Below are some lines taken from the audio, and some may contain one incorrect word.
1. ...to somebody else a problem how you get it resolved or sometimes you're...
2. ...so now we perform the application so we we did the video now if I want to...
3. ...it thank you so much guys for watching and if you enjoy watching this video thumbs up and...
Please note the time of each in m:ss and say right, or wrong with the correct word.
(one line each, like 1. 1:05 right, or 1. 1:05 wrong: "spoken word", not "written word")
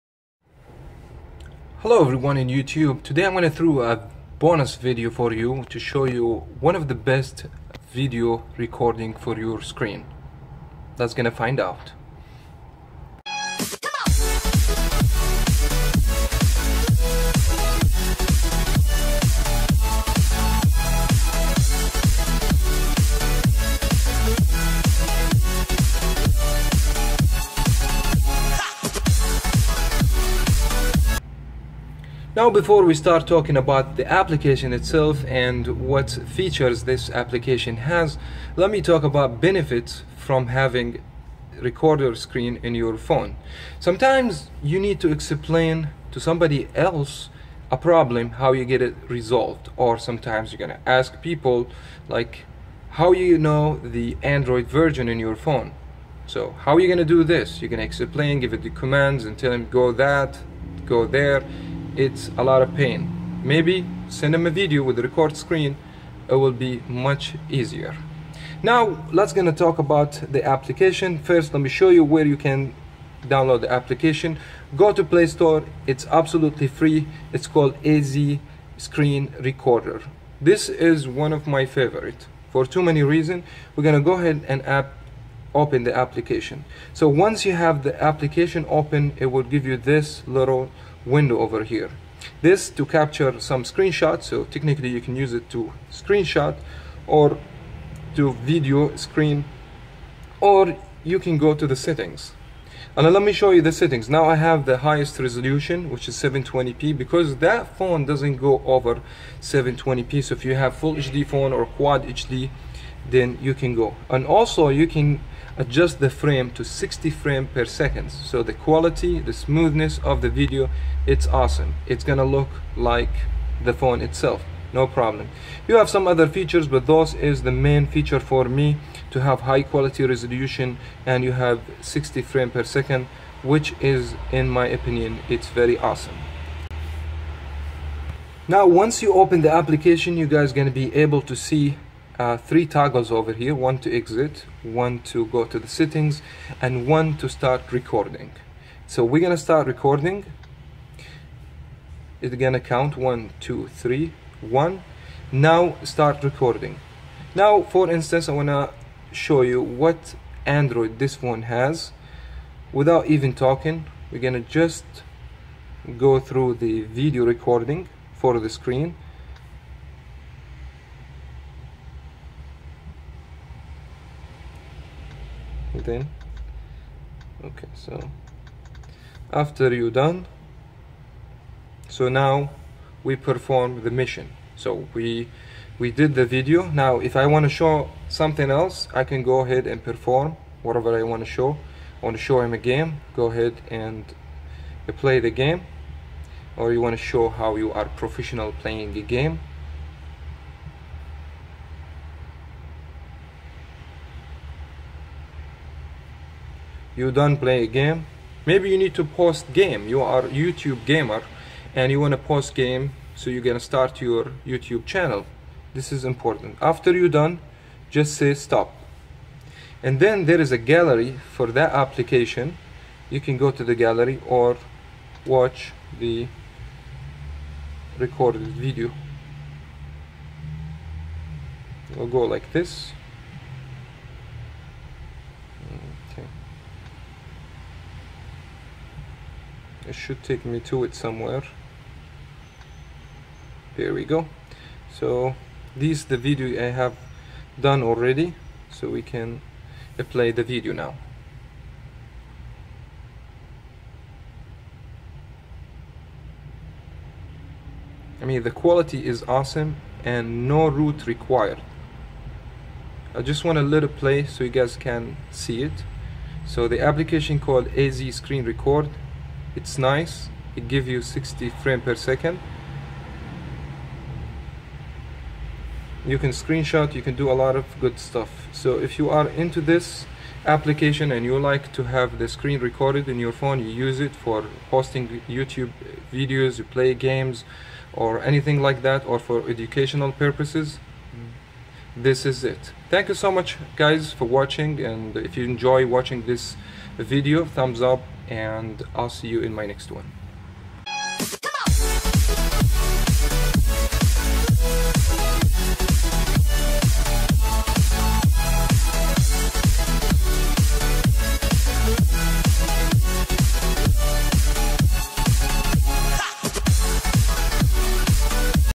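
1. 0:46 right
2. 3:01 wrong: "mission", not "application"
3. 4:52 right.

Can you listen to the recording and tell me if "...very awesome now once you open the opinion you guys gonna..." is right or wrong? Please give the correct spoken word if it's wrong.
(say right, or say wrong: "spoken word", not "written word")
wrong: "application", not "opinion".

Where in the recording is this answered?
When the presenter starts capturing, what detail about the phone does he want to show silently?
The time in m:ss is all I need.
2:39.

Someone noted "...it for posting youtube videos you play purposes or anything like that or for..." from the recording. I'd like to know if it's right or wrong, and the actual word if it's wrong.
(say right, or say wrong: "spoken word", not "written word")
wrong: "games", not "purposes".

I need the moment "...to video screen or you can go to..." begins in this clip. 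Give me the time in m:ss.
1:38.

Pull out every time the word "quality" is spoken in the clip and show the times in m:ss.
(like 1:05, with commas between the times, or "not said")
1:58, 2:09, 4:18.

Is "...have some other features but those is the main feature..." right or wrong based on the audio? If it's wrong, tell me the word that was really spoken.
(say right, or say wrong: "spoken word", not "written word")
right.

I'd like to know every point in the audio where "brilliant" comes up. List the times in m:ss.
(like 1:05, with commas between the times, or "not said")
not said.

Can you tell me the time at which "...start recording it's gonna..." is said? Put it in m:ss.
2:29.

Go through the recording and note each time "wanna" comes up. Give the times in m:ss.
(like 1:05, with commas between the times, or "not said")
2:38.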